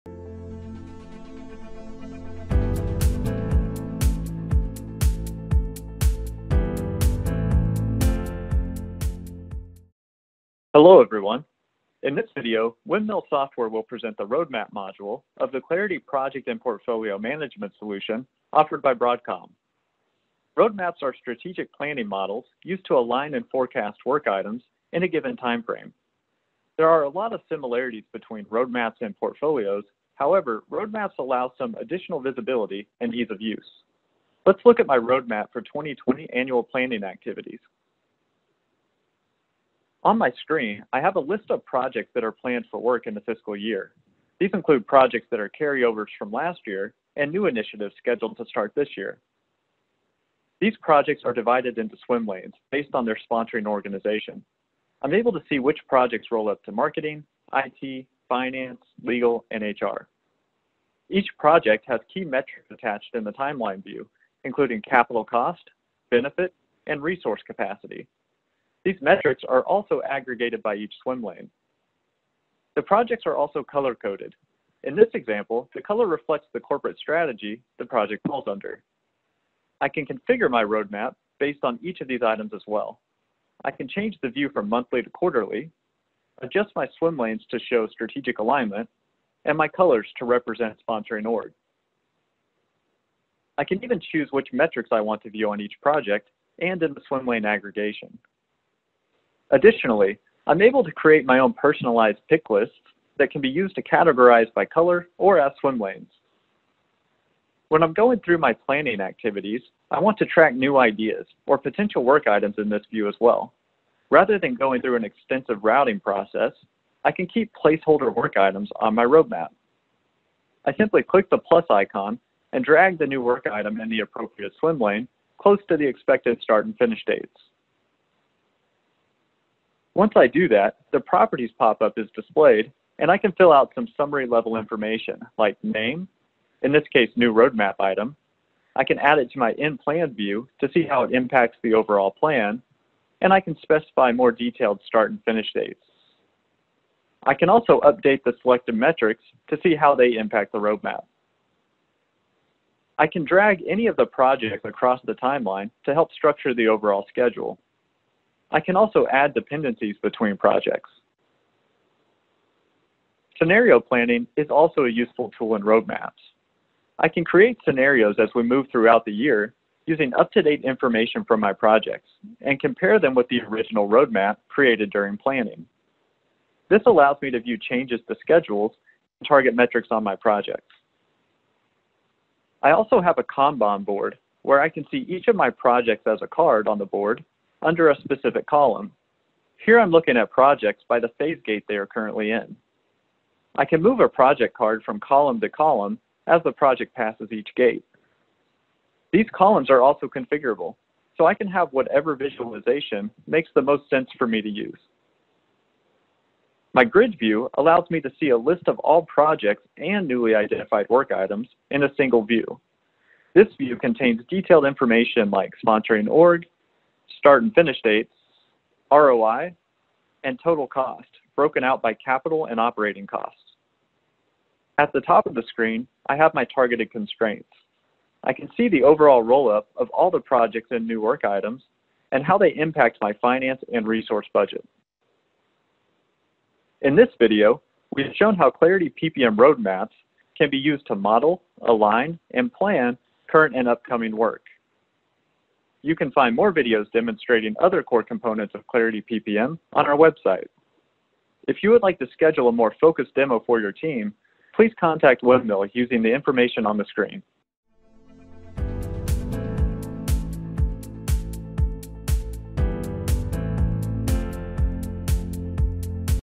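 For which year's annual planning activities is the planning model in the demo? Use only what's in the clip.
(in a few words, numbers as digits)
2020.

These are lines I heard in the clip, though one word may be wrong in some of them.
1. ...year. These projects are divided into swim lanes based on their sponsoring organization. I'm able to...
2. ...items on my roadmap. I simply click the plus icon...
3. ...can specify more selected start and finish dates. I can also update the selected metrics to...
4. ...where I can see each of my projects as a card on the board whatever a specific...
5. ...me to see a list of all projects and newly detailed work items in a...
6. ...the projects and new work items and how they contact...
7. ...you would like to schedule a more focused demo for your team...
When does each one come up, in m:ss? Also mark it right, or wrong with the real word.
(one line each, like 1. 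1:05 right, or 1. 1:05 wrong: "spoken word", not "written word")
1. 0:48 right
2. 1:58 right
3. 2:23 wrong: "detailed", not "selected"
4. 3:04 wrong: "under", not "whatever"
5. 3:27 wrong: "identified", not "detailed"
6. 3:50 wrong: "impact", not "contact"
7. 4:11 right.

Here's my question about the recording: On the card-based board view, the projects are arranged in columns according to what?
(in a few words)
phase gate.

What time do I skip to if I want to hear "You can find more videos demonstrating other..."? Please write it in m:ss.
4:05.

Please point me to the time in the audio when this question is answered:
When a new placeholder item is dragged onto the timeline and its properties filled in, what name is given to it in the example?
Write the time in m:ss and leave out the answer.
2:17.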